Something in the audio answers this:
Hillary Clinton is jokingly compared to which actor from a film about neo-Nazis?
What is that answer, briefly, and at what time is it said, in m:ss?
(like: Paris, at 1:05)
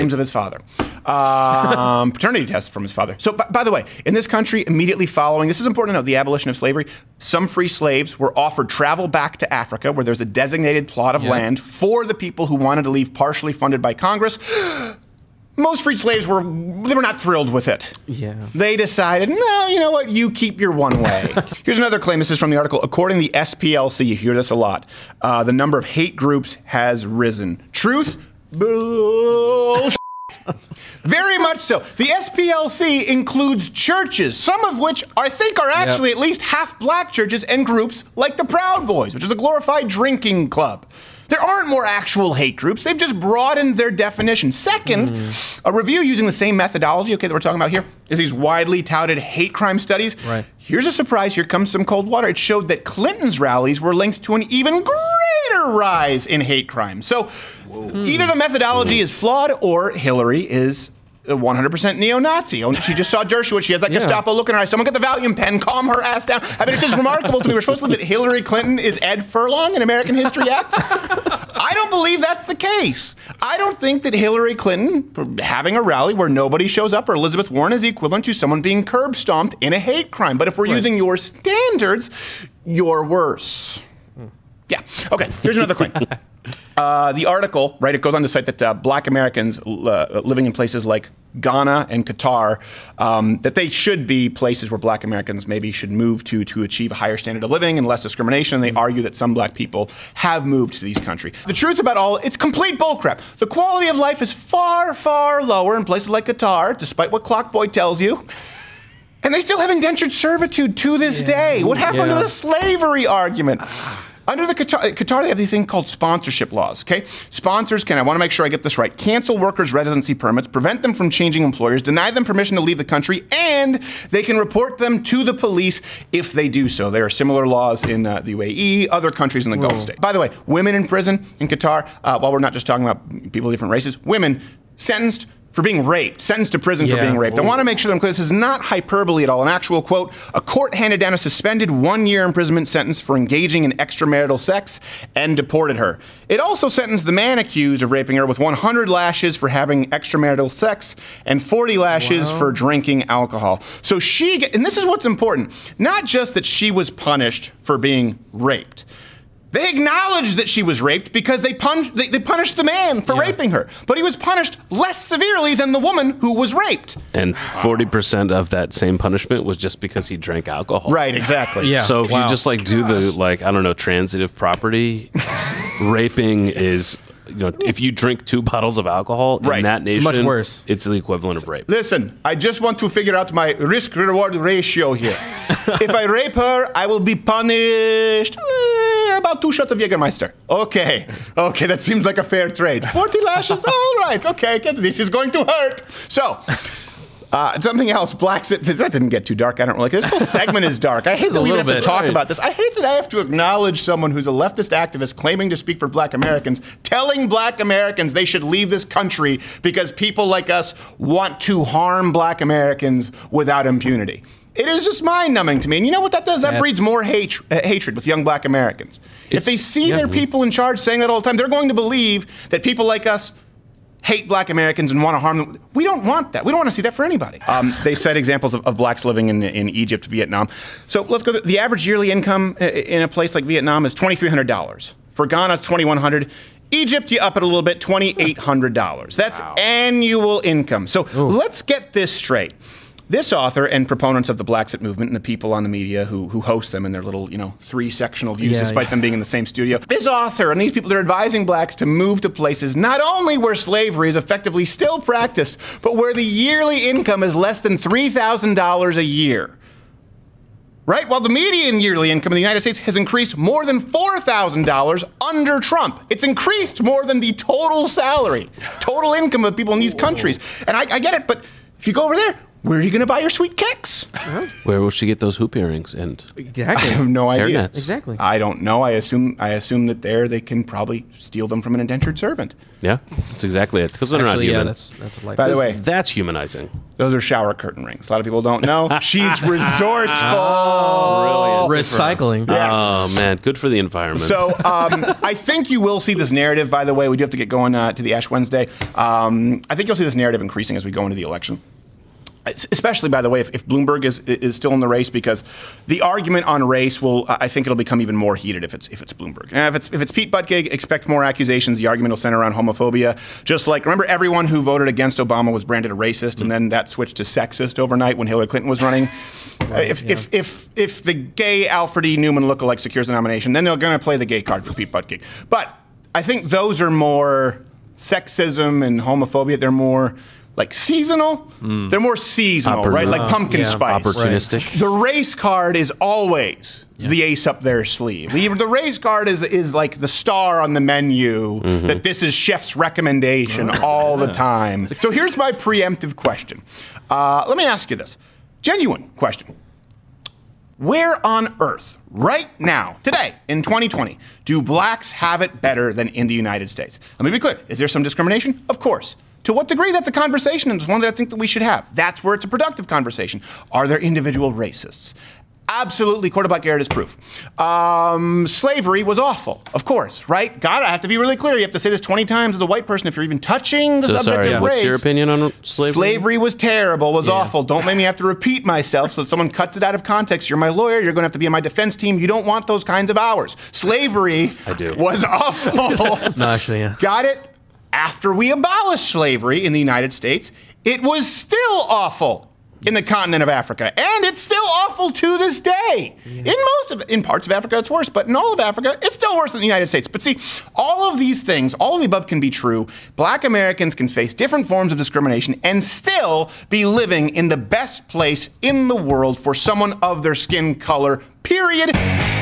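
Ed Furlong, at 1:09.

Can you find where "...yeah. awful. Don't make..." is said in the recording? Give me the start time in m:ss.
6:17.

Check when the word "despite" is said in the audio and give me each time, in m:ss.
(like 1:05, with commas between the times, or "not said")
1:46, 4:08.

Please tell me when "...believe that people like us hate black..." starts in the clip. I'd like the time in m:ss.
3:41.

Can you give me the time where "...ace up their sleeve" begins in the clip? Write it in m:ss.
5:37.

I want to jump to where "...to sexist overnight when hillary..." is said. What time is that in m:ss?
5:17.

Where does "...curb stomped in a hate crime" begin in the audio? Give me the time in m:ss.
1:18.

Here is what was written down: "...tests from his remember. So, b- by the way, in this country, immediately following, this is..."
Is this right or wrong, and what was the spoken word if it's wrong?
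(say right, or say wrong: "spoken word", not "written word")
wrong: "father", not "remember".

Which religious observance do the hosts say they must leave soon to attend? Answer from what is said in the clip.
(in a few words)
Ash Wednesday.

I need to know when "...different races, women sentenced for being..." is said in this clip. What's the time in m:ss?
2:13.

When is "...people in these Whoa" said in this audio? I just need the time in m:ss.
4:29.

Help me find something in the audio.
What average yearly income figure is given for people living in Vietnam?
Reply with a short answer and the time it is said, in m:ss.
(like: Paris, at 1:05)
$2,300, at 3:53.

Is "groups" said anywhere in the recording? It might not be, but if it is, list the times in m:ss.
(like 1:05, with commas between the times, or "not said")
0:26, 0:37, 0:42.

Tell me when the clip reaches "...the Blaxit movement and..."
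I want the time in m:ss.
4:04.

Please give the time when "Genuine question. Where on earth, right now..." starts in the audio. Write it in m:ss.
5:48.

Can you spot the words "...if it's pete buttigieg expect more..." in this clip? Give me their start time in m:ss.
5:09.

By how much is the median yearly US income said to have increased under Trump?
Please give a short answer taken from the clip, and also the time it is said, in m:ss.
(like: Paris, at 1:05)
$4,000, at 4:23.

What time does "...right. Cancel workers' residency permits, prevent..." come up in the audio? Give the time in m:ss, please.
1:58.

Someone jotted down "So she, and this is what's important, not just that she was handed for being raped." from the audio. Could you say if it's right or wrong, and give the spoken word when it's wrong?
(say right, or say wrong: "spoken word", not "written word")
wrong: "punished", not "handed".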